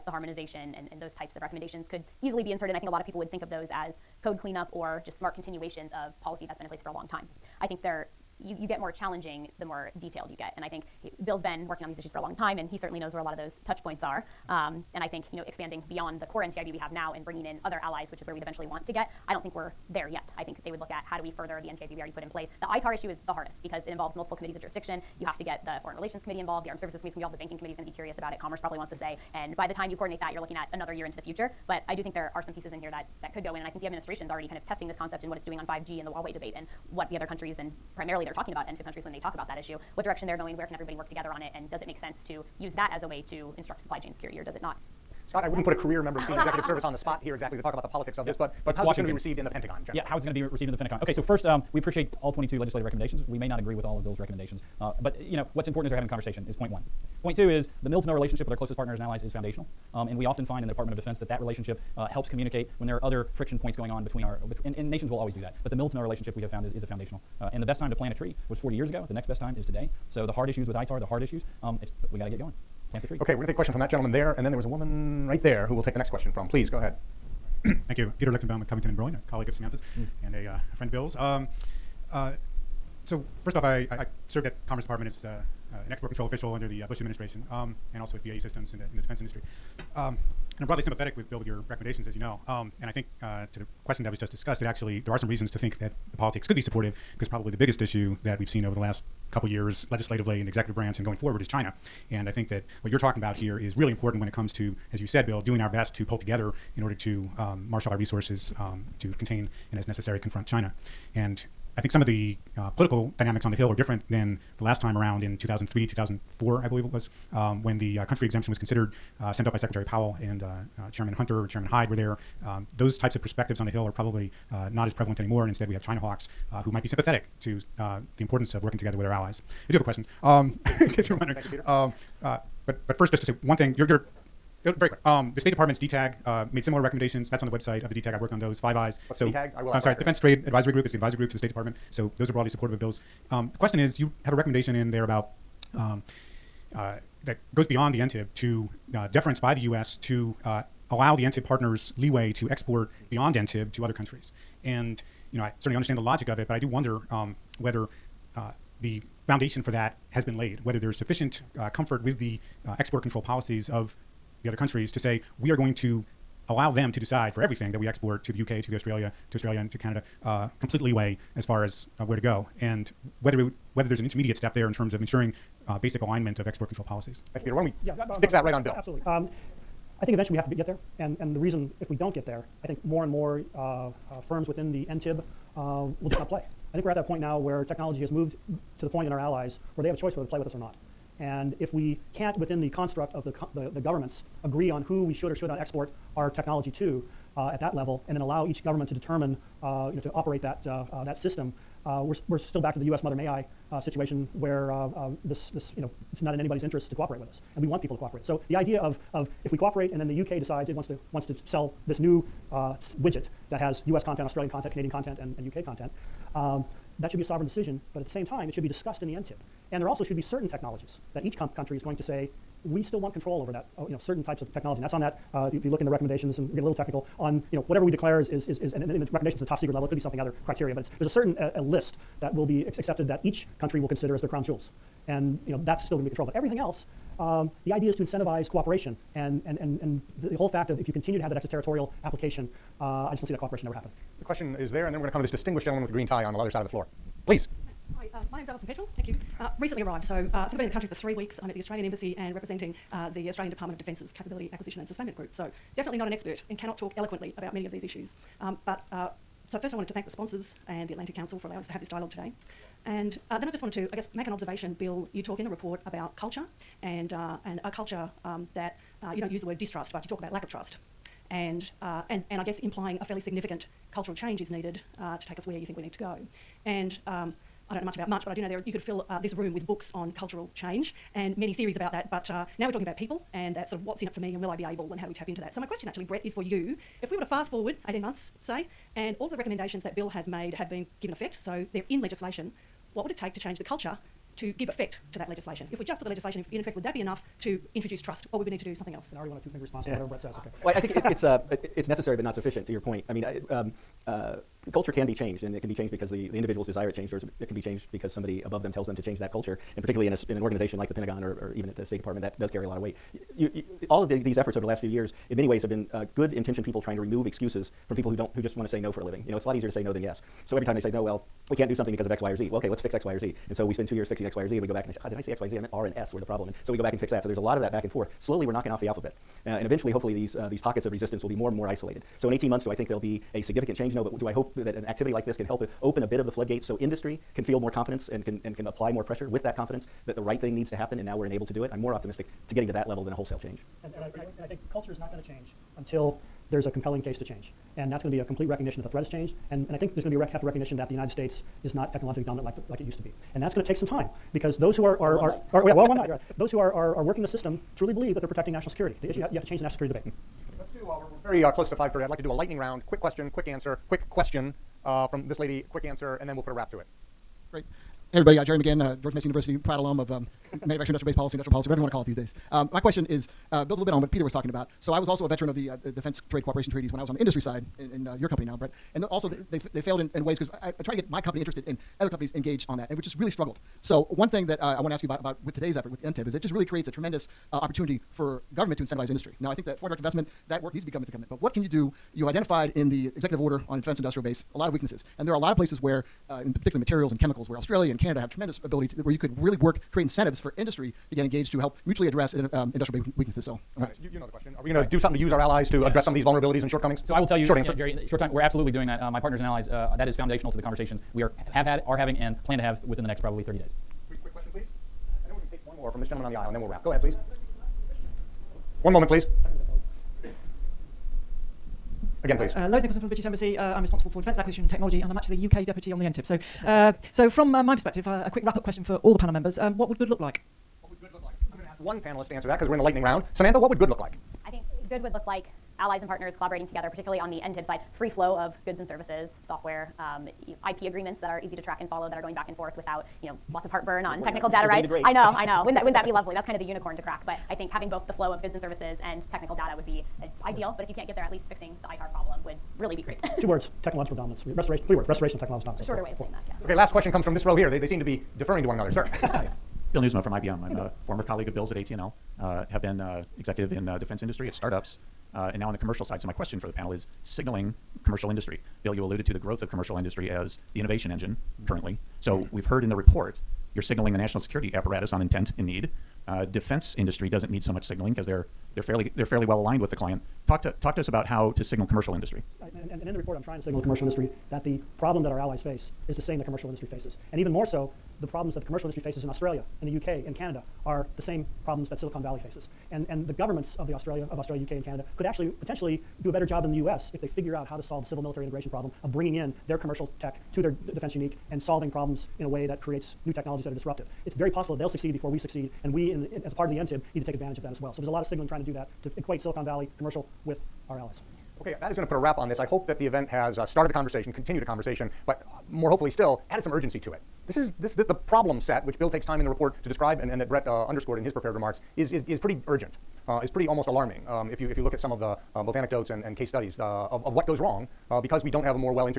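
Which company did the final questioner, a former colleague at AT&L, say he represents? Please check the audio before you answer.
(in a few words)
IBM.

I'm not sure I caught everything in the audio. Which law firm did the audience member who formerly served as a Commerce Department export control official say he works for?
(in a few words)
Covington and Burling.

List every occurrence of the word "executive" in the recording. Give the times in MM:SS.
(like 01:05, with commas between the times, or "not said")
00:46, 01:40, 06:33, 07:43.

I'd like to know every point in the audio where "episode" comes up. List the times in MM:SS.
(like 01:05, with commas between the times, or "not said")
not said.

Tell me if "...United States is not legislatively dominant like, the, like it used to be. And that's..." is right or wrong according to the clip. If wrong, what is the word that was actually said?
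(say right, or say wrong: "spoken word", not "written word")
wrong: "technologically", not "legislatively".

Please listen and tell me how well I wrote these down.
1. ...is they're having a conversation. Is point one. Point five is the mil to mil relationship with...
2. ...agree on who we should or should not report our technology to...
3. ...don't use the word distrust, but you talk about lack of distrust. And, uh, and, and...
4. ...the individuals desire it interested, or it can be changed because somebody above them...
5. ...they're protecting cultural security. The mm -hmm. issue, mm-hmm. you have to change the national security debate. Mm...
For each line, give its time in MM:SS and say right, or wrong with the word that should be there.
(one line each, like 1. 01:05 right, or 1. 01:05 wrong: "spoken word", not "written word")
1. 00:55 wrong: "two", not "five"
2. 03:14 wrong: "export", not "report"
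3. 04:29 wrong: "trust", not "distrust"
4. 05:06 wrong: "changed", not "interested"
5. 05:58 wrong: "national", not "cultural".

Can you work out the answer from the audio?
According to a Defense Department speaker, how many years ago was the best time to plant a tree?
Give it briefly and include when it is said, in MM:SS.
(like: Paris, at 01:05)
40 years, at 01:08.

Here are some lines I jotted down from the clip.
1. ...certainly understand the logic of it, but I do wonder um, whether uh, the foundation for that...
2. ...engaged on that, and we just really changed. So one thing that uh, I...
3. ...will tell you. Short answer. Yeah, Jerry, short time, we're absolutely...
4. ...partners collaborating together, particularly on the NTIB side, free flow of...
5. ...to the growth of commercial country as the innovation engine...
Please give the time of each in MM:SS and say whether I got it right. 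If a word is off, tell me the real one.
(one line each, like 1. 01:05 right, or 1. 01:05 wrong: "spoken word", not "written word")
1. 02:35 right
2. 06:22 wrong: "struggled", not "changed"
3. 06:47 right
4. 07:16 right
5. 07:49 wrong: "industry", not "country".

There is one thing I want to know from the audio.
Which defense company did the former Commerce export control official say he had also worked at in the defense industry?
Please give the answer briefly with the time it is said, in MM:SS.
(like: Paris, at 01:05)
BAE Systems, at 01:28.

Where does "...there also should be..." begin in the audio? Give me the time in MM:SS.
03:39.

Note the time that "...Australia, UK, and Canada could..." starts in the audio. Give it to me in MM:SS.
08:14.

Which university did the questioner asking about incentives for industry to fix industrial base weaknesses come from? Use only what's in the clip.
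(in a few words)
George Mason University.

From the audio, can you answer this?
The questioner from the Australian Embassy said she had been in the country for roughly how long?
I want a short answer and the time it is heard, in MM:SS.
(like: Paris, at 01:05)
3 weeks, at 04:10.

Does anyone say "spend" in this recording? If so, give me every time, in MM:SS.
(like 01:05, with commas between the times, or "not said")
05:23.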